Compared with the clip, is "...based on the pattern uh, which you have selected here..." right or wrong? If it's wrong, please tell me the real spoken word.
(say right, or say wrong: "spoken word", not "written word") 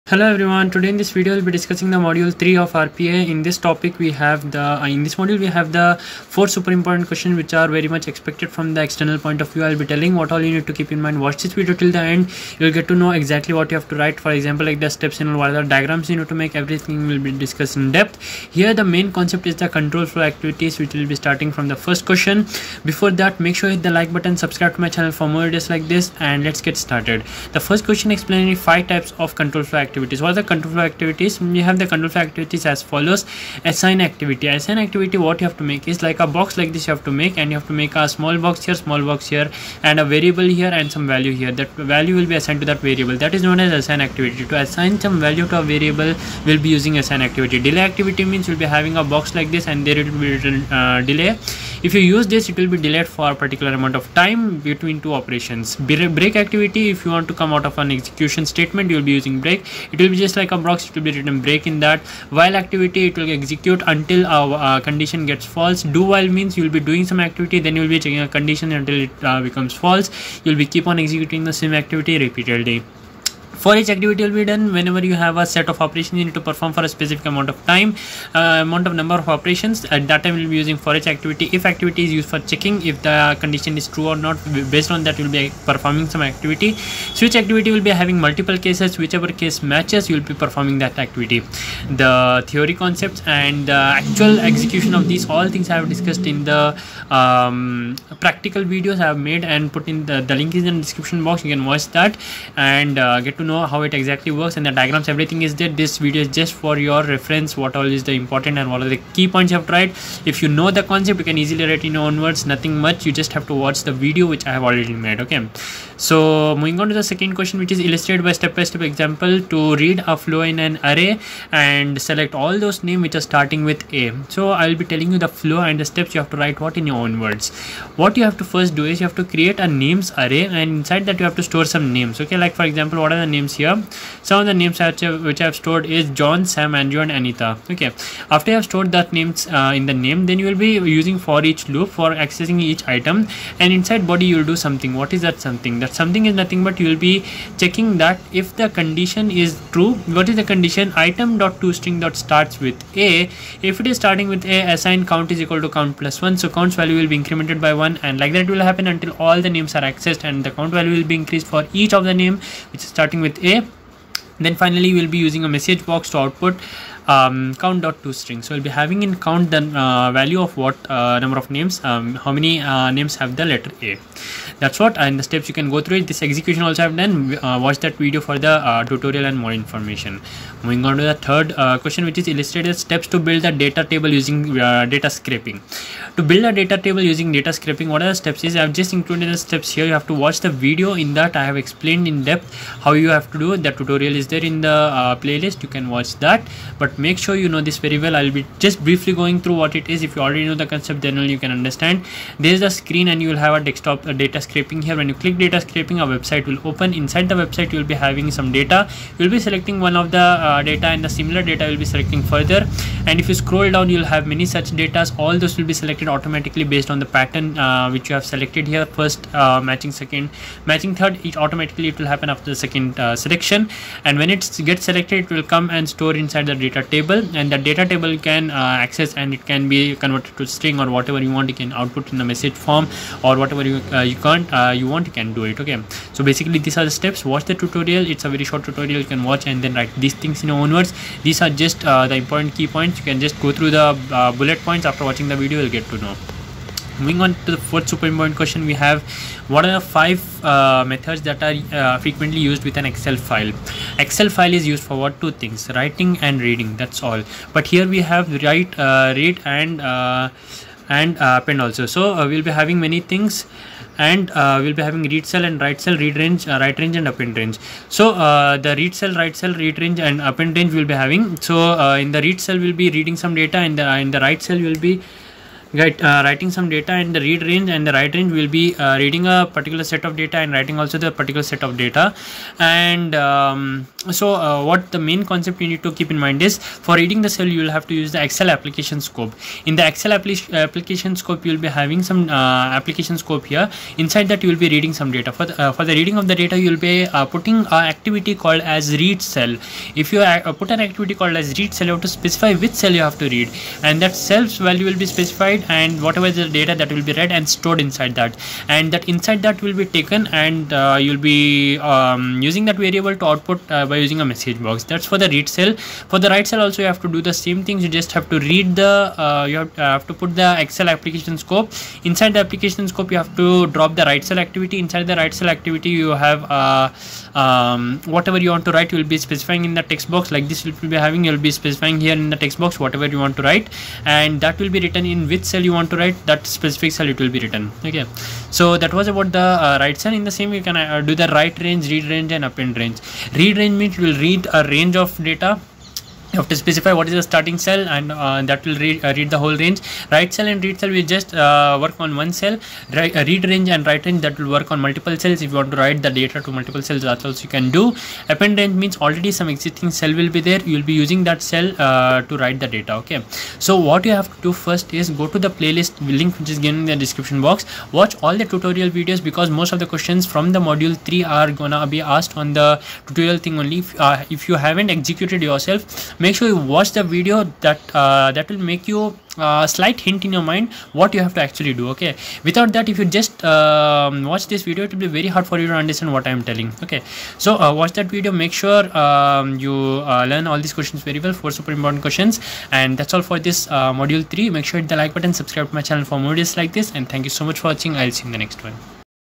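right.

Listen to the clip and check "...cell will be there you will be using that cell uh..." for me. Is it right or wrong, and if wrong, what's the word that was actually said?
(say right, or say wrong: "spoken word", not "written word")
right.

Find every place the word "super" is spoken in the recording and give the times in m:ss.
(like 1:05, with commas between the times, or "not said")
0:06, 4:07, 6:31.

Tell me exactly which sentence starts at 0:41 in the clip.
That value will be assigned to that variable.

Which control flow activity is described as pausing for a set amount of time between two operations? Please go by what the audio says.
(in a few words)
Delay activity.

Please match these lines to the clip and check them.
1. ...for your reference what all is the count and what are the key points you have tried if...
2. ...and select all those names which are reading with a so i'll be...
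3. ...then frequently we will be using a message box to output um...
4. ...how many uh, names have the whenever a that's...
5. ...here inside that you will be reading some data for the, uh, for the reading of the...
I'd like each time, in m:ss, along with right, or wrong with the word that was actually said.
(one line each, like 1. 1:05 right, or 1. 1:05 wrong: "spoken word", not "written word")
1. 1:46 wrong: "important", not "count"
2. 2:01 wrong: "starting", not "reading"
3. 2:44 wrong: "finally", not "frequently"
4. 2:52 wrong: "letter", not "whenever"
5. 4:53 right.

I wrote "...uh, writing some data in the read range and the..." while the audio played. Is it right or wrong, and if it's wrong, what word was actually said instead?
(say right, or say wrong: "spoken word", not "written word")
right.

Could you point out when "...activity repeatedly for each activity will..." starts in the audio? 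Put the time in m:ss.
1:11.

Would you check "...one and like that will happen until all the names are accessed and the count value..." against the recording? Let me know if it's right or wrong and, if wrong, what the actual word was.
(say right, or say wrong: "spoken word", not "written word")
right.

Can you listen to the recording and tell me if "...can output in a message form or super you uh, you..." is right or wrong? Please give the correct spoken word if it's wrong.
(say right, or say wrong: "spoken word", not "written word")
wrong: "whatever", not "super".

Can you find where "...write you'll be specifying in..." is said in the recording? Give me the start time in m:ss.
5:28.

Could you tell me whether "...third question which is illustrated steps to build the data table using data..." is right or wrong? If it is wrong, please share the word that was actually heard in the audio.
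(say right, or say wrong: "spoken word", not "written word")
right.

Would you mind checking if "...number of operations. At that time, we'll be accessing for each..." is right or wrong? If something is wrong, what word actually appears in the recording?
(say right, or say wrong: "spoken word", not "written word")
wrong: "using", not "accessing".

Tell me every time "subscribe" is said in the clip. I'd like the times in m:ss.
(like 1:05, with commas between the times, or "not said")
0:24, 6:35.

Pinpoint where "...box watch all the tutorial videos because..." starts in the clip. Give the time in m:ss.
6:07.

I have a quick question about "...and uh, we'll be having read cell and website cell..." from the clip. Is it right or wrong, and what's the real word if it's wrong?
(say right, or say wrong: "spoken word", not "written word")
wrong: "write", not "website".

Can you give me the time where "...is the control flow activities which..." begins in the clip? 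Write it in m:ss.
0:19.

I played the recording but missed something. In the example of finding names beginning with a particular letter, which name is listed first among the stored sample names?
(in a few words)
John.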